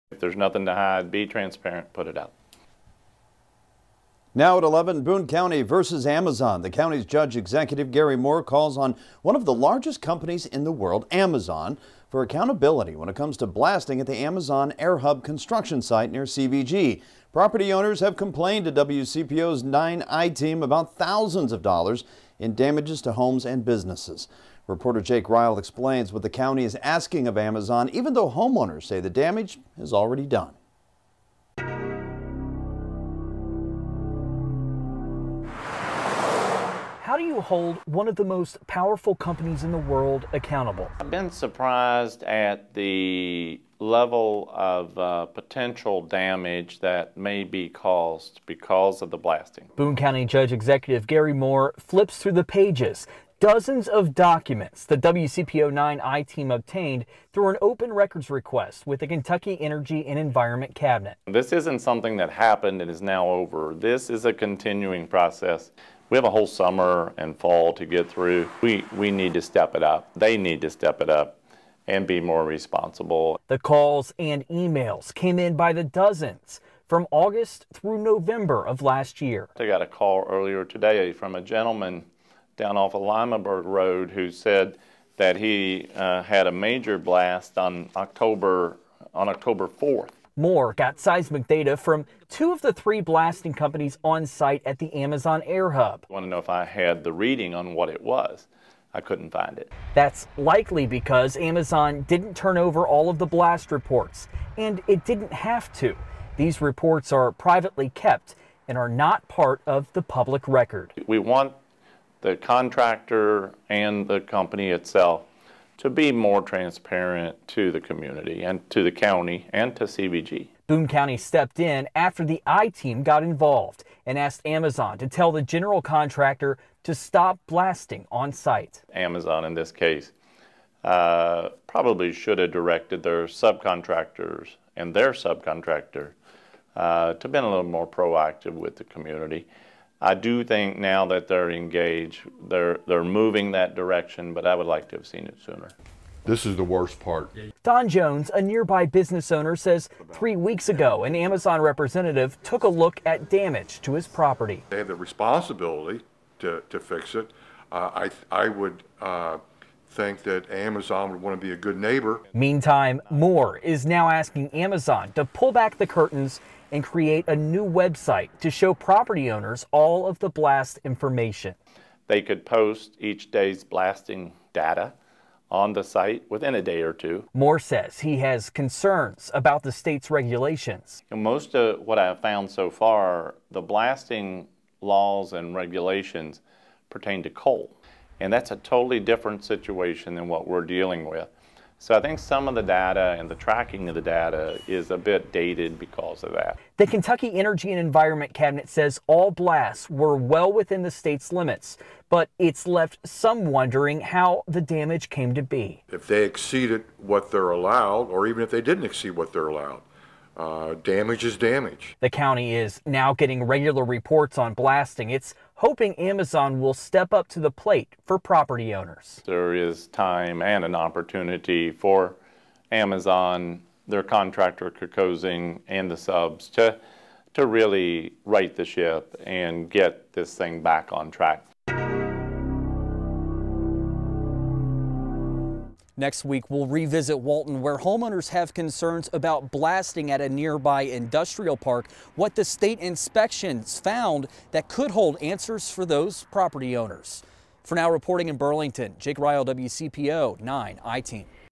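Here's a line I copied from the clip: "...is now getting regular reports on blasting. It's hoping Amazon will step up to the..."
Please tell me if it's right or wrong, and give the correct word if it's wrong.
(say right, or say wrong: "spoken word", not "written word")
right.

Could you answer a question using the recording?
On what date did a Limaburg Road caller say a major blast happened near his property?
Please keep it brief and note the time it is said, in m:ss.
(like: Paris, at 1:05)
October 4, at 1:29.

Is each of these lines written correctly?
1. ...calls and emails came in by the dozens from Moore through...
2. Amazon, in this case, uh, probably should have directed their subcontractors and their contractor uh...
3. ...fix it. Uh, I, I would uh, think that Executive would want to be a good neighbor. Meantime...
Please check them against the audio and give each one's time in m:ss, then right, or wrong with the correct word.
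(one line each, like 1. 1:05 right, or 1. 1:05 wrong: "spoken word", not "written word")
1. 1:13 wrong: "August", not "Moore"
2. 2:08 wrong: "subcontractor", not "contractor"
3. 2:36 wrong: "Amazon", not "Executive".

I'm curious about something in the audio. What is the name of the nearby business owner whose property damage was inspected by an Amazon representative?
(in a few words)
Don Jones.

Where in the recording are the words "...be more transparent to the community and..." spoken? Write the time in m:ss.
1:55.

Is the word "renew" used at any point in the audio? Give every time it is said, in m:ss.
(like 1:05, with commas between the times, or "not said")
not said.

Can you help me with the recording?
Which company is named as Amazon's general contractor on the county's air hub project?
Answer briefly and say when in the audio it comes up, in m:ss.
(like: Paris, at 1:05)
Kokosing, at 3:44.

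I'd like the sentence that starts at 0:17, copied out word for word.
Property owners have complained to WCPO's 9i team about thousands of dollars in damages to homes and businesses.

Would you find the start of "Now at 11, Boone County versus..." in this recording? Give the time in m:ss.
0:04.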